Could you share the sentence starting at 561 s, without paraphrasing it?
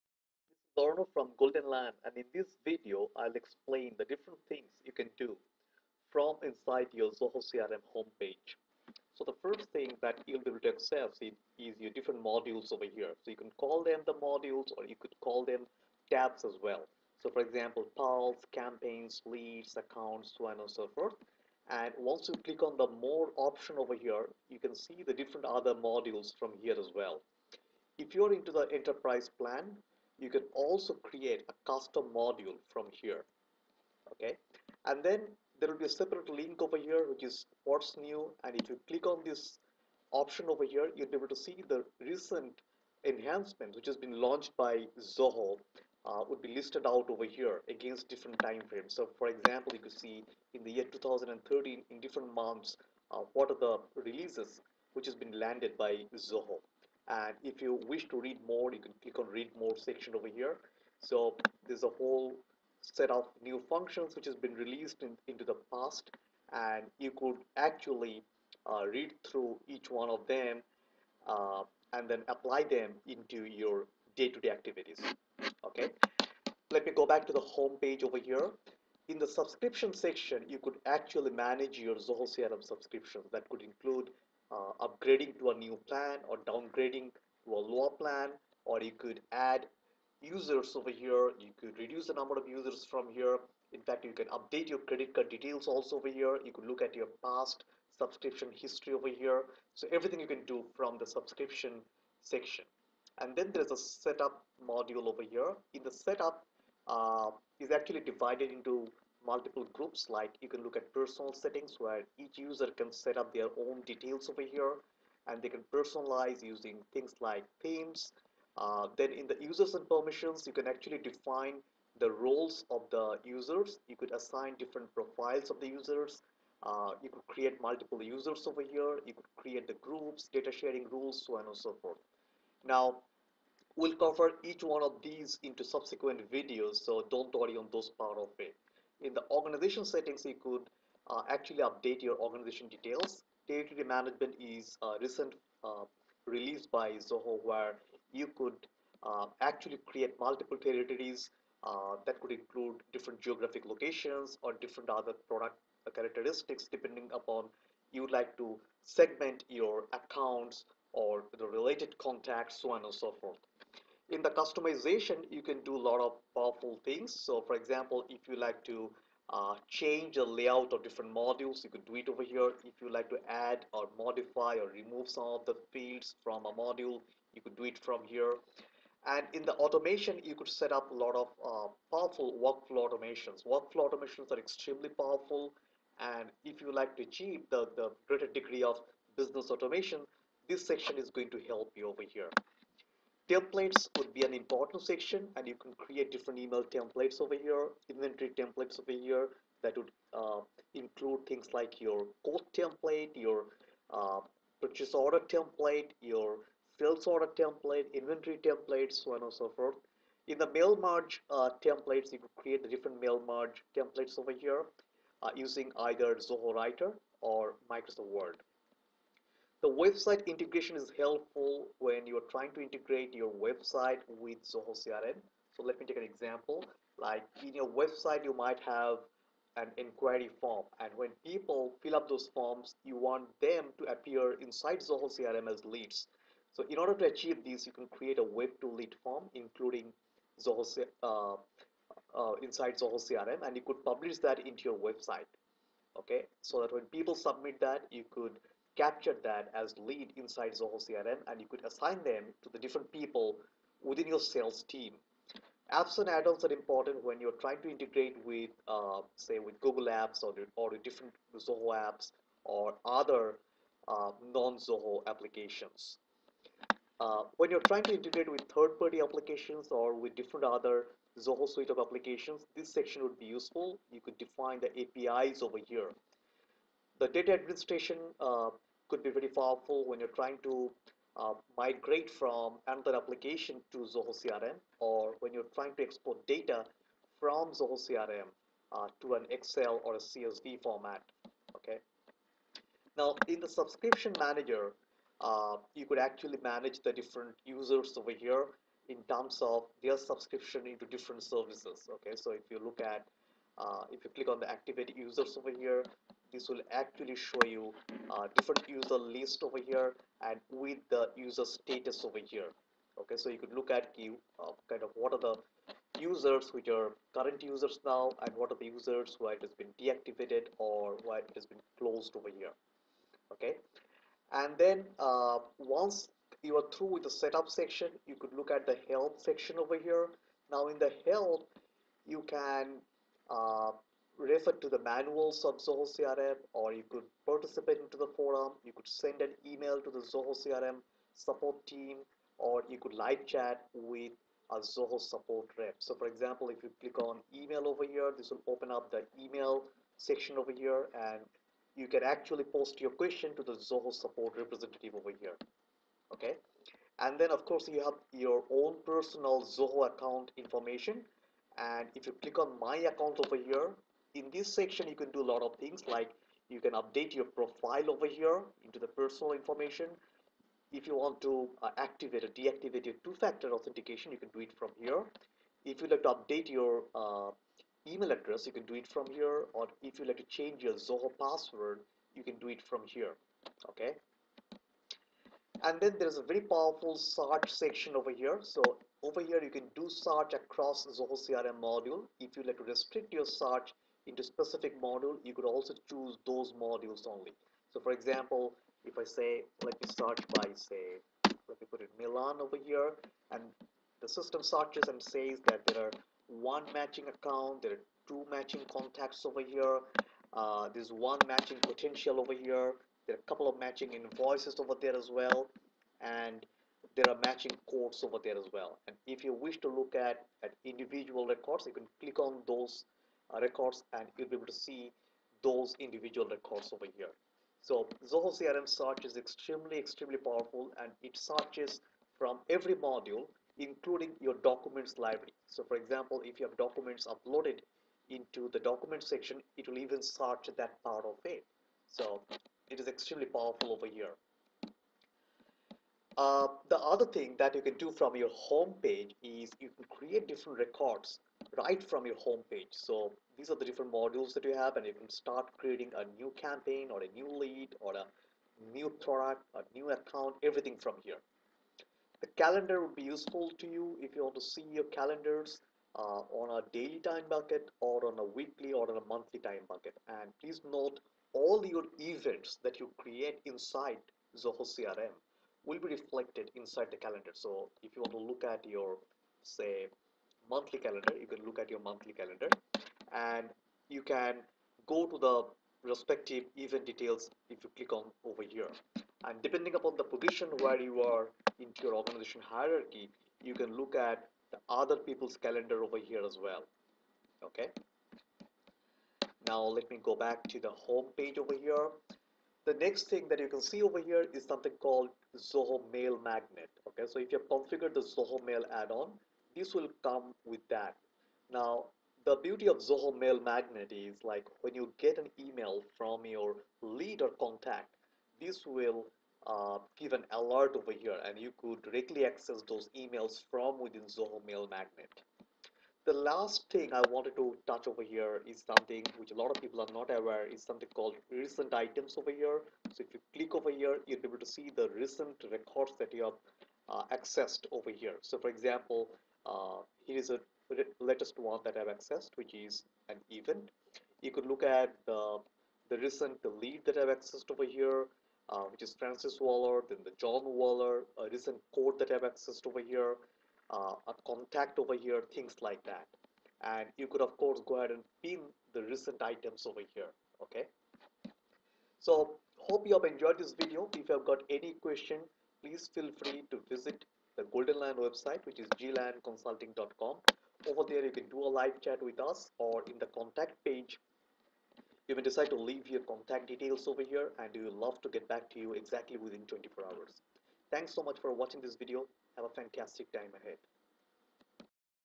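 So, hope you have enjoyed this video.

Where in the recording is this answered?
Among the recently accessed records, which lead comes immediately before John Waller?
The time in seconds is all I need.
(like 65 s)
548 s.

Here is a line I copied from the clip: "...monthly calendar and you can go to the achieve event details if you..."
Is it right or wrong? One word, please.
wrong.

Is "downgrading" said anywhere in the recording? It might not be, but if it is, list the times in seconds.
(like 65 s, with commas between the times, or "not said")
86 s.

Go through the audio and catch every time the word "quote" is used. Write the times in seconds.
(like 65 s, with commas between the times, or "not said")
202 s, 417 s, 551 s.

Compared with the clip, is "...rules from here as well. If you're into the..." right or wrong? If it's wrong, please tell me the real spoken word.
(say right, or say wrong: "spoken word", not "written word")
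wrong: "modules", not "rules".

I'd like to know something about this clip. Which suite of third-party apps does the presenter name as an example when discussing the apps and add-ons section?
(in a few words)
Google Apps.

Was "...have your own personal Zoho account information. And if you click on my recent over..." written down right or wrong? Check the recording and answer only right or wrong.
wrong.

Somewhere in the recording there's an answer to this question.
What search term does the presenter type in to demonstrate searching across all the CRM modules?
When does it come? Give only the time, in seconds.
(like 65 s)
401 s.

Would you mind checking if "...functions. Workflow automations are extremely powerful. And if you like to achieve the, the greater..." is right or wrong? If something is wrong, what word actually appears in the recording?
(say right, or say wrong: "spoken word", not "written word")
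wrong: "automations", not "functions".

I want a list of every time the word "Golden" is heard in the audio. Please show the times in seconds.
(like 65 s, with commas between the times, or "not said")
1 s, 567 s.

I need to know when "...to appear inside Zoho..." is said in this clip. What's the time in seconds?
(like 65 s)
233 s.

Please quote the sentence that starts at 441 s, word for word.
So it is extremely powerful over here.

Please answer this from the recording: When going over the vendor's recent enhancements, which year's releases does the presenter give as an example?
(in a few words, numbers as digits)
2013.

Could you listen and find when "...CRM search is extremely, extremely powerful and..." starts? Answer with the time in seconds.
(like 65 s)
428 s.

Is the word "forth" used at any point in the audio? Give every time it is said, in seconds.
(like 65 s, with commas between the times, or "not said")
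20 s, 131 s, 163 s, 209 s.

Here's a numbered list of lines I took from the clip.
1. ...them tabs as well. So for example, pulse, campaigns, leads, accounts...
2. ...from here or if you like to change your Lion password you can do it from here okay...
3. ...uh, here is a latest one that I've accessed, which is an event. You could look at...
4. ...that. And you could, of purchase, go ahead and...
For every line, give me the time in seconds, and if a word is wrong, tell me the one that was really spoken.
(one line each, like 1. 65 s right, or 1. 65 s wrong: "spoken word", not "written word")
1. 15 s right
2. 378 s wrong: "Zoho", not "Lion"
3. 539 s right
4. 555 s wrong: "course", not "purchase".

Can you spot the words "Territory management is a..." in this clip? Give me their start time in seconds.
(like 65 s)
143 s.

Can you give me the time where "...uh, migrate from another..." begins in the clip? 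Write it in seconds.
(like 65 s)
281 s.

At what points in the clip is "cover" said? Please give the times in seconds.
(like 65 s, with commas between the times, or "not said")
133 s.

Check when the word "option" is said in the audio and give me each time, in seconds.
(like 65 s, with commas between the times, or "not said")
23 s, 40 s.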